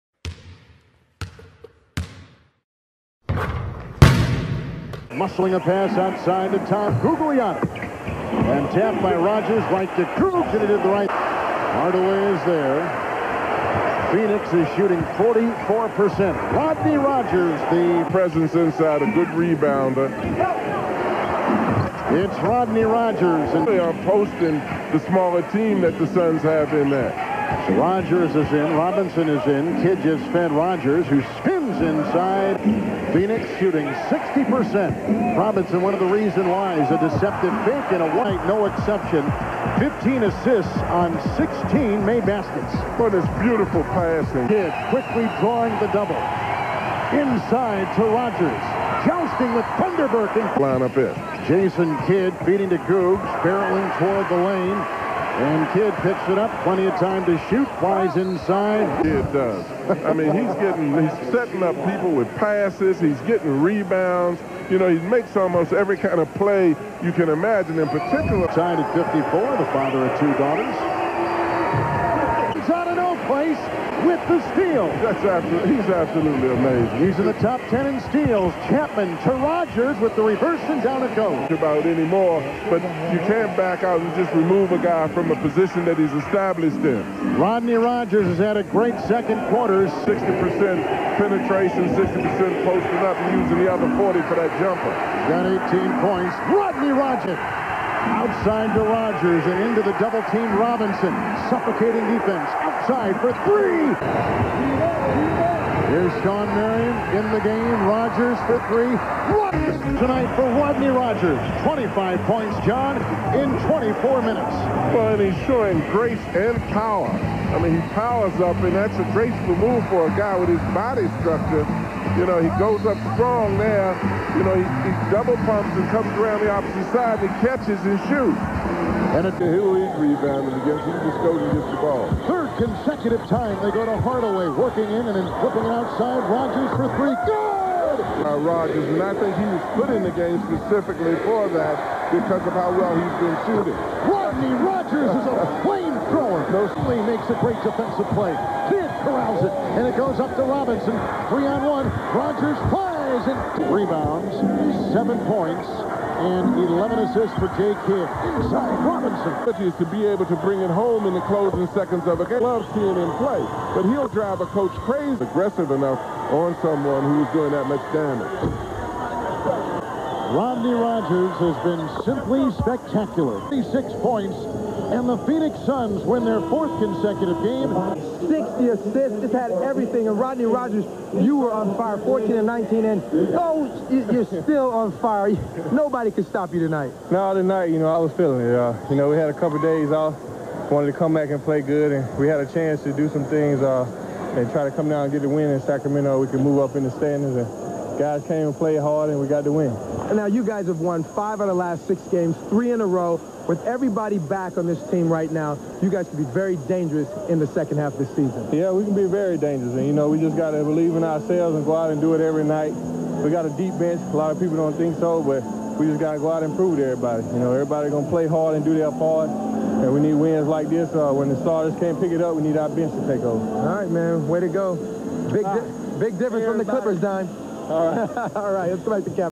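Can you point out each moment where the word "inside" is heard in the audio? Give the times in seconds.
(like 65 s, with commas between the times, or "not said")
18 s, 31 s, 47 s, 58 s, 158 s.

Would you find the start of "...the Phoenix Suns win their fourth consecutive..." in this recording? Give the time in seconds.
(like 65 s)
175 s.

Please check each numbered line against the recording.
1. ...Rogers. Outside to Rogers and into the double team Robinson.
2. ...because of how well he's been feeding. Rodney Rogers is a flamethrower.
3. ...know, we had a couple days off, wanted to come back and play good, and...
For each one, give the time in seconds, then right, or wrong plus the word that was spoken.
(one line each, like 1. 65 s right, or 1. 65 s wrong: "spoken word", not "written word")
1. 96 s right
2. 142 s wrong: "shooting", not "feeding"
3. 188 s right.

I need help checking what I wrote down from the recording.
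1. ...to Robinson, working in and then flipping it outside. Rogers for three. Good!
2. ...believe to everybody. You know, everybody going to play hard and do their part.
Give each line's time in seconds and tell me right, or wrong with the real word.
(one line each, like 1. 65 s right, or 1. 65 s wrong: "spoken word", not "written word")
1. 133 s wrong: "Hardaway", not "Robinson"
2. 216 s wrong: "prove", not "believe".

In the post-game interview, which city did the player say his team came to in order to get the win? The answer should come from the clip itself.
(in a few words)
Sacramento.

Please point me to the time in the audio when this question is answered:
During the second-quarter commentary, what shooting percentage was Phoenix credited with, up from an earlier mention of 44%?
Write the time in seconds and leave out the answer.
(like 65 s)
33 s.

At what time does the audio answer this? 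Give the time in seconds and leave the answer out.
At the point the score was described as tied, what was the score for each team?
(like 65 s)
68 s.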